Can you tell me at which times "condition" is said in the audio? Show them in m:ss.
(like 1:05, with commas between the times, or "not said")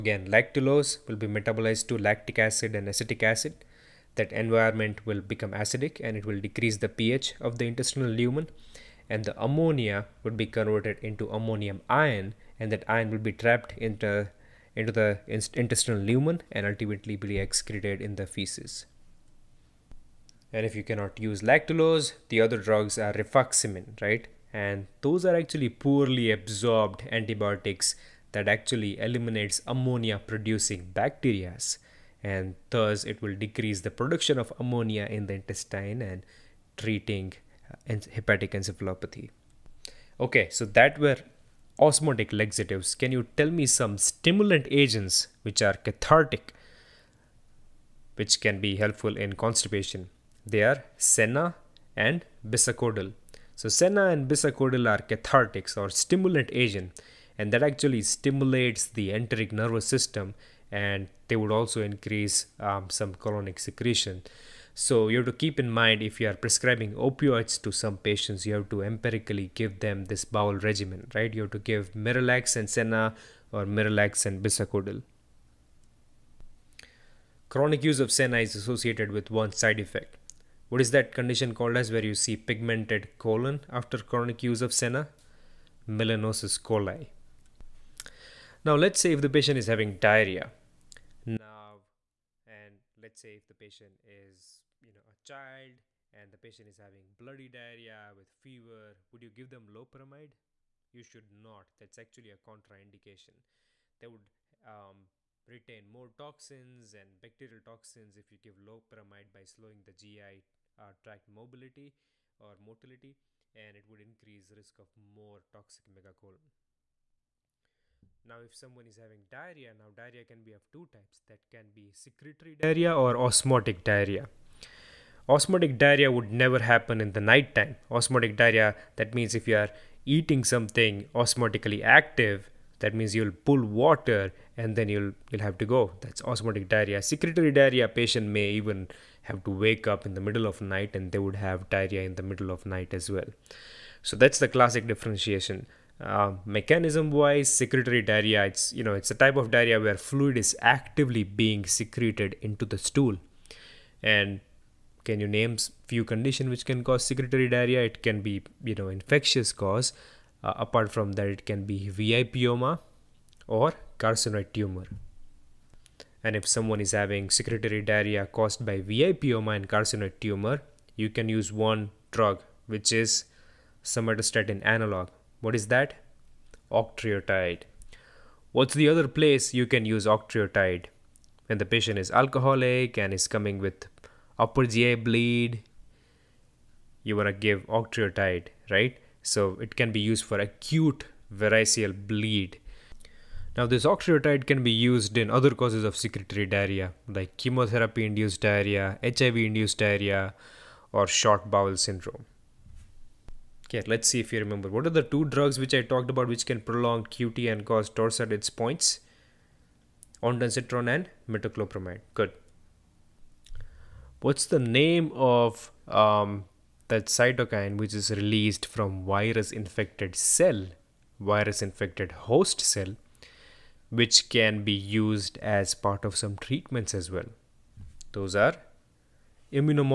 1:21, 2:36.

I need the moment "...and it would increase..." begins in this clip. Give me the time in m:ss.
1:53.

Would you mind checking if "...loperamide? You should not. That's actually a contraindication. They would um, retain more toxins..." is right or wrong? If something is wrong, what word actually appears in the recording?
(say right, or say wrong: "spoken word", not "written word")
right.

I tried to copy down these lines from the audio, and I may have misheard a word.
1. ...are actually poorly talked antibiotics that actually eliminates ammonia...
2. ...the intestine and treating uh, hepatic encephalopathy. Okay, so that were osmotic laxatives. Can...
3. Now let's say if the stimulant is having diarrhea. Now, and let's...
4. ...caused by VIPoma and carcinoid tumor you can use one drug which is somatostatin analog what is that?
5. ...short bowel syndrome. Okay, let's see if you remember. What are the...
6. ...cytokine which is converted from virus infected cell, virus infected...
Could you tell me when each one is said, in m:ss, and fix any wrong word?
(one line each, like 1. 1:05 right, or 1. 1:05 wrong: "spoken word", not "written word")
1. 0:25 wrong: "absorbed", not "talked"
2. 0:35 right
3. 1:28 wrong: "patient", not "stimulant"
4. 2:48 right
5. 3:21 right
6. 3:37 wrong: "released", not "converted".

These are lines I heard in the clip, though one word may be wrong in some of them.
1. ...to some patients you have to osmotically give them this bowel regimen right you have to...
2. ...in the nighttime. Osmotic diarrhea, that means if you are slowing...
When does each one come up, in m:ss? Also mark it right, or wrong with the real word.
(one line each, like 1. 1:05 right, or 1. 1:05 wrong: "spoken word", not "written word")
1. 1:07 wrong: "empirically", not "osmotically"
2. 2:07 wrong: "eating", not "slowing".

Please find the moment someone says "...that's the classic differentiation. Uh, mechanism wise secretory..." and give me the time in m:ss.
2:24.